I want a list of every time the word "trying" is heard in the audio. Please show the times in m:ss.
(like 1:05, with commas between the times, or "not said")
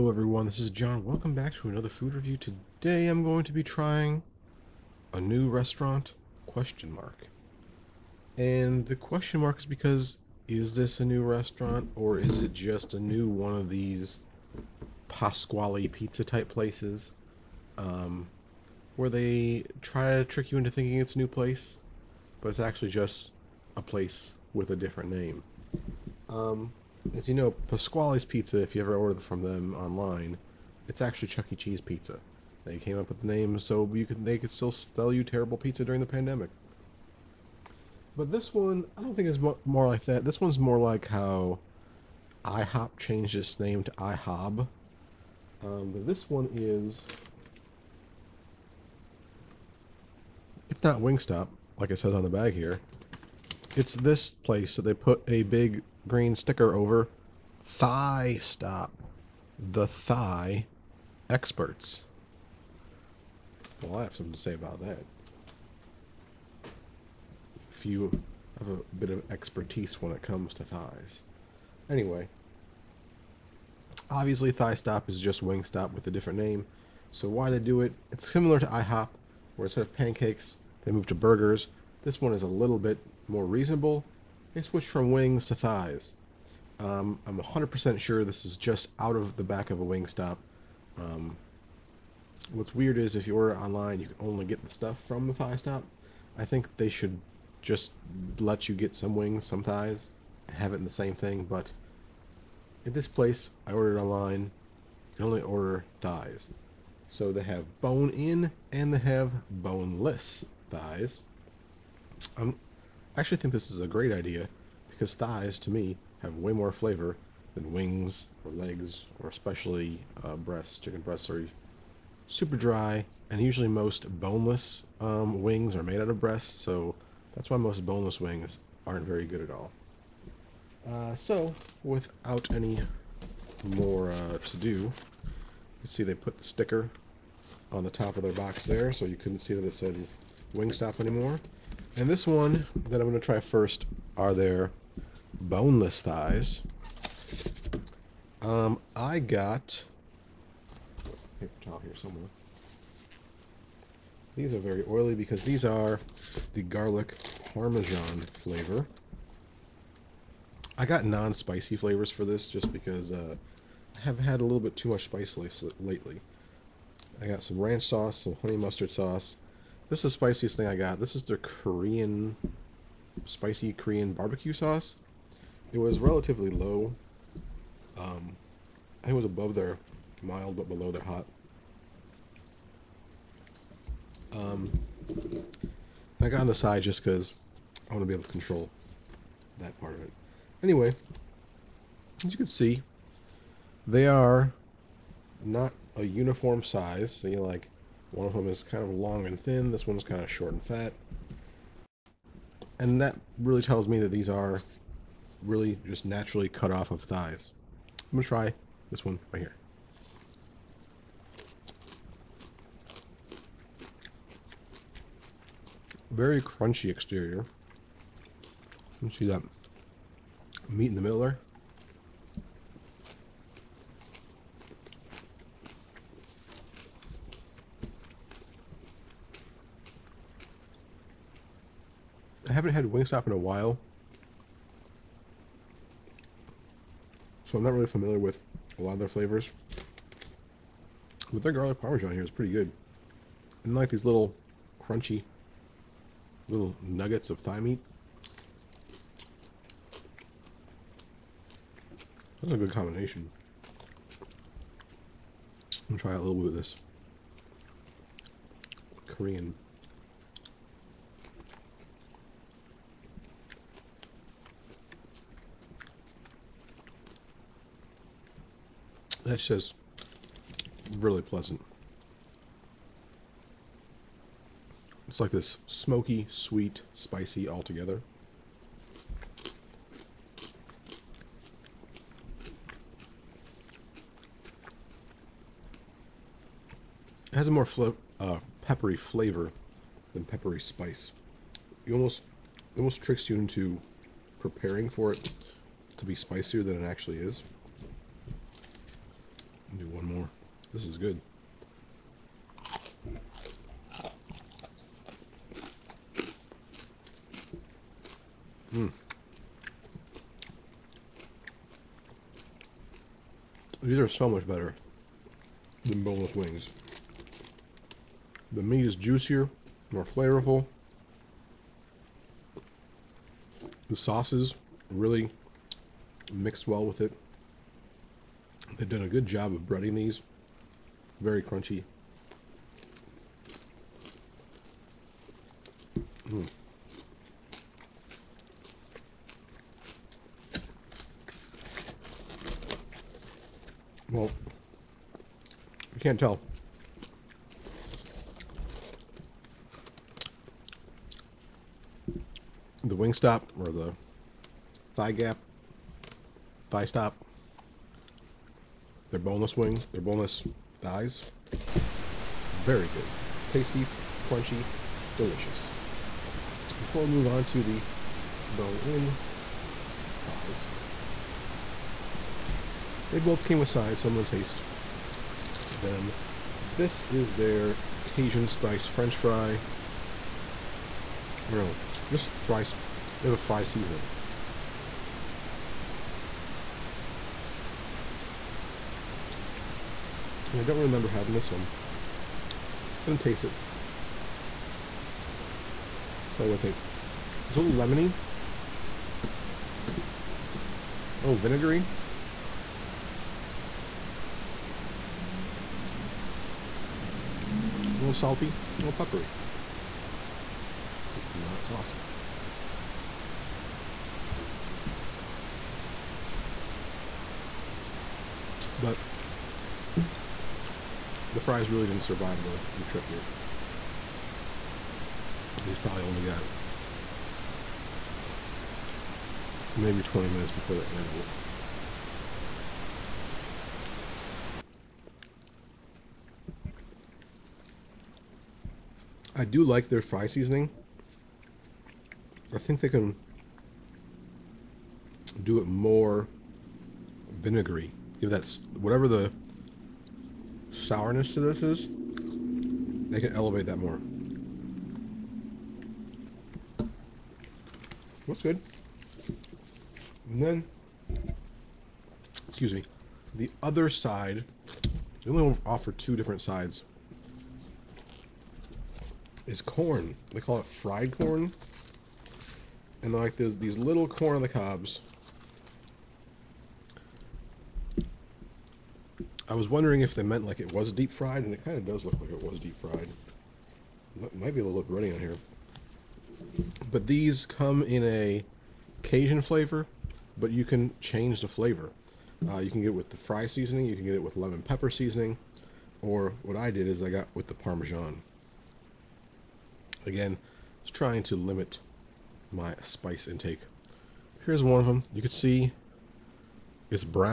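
0:03, 8:20.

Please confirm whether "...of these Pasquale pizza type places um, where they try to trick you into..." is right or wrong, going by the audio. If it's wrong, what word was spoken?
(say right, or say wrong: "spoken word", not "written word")
right.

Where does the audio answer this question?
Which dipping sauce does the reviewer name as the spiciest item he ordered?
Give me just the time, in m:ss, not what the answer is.
2:53.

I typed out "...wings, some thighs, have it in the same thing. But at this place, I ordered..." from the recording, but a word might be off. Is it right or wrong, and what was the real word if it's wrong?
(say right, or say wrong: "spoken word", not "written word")
right.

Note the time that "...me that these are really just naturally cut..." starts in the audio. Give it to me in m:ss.
3:23.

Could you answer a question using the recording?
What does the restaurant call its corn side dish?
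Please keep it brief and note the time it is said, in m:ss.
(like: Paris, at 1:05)
Fried corn, at 7:50.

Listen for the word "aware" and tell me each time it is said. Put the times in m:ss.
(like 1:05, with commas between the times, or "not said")
not said.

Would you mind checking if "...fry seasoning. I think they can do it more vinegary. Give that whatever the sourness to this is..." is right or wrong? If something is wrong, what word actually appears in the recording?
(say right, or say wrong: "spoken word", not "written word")
right.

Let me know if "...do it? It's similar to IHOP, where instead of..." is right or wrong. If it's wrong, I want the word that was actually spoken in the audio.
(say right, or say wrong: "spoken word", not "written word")
right.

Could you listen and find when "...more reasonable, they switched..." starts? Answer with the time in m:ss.
1:23.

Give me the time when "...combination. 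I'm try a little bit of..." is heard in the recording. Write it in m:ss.
4:12.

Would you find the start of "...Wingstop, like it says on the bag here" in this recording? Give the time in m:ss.
0:51.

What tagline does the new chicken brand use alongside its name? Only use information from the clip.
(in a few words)
The Thigh Experts.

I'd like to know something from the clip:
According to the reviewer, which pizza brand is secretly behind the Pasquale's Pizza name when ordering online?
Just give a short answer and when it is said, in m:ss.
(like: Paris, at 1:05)
Chuck E. Cheese, at 0:31.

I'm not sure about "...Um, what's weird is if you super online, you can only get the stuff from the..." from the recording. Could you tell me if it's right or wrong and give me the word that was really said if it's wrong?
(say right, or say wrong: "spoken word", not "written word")
wrong: "order", not "super".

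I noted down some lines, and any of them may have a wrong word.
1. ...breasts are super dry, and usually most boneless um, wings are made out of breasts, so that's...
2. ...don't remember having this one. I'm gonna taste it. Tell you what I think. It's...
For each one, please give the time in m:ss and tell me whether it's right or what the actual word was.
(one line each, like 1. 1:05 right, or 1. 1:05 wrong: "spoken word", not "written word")
1. 2:01 right
2. 6:30 right.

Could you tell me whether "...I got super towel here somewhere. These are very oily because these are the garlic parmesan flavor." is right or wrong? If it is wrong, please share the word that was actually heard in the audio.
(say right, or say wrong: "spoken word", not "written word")
wrong: "paper", not "super".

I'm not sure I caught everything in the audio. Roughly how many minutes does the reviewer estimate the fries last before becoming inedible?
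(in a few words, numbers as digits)
20.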